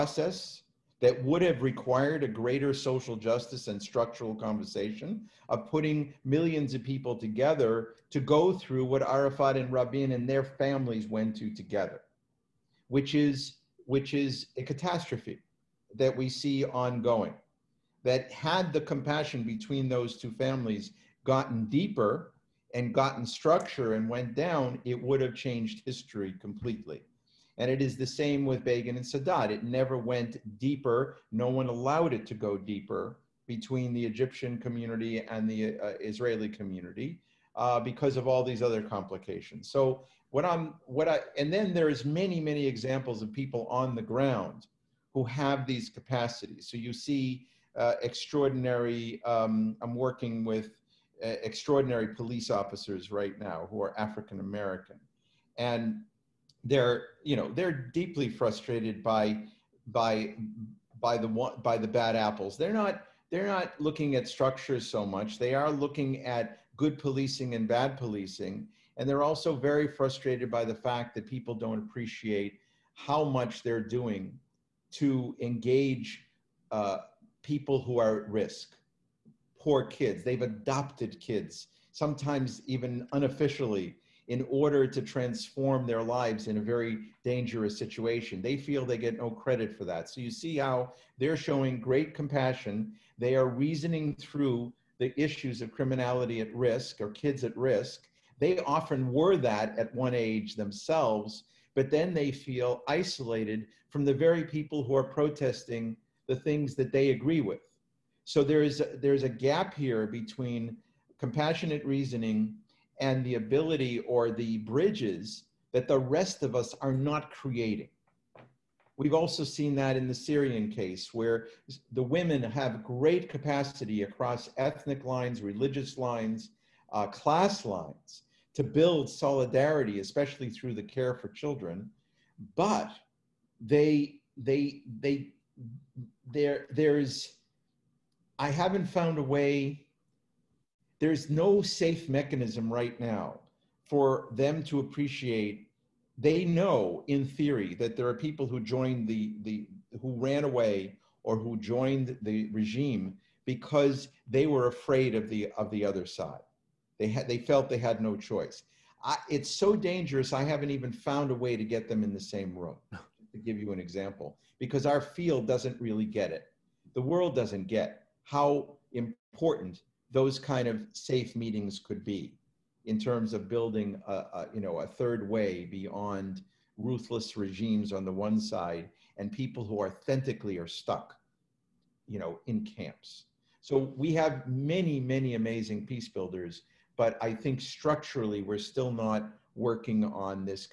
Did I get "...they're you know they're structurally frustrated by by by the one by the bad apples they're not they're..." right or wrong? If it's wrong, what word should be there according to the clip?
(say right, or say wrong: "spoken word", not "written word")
wrong: "deeply", not "structurally".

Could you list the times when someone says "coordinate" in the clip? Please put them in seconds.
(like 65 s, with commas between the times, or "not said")
not said.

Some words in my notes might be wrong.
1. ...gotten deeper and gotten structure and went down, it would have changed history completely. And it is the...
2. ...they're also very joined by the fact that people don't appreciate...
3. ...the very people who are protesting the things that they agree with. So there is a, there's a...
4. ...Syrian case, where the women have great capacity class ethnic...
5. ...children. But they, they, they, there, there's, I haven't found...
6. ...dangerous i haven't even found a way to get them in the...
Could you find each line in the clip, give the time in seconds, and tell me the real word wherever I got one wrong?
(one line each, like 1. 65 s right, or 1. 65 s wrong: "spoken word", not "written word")
1. 21 s right
2. 69 s wrong: "frustrated", not "joined"
3. 104 s right
4. 120 s wrong: "across", not "class"
5. 131 s right
6. 159 s right.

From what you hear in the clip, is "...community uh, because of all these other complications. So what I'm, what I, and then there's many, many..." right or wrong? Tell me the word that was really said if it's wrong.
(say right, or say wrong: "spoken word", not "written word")
right.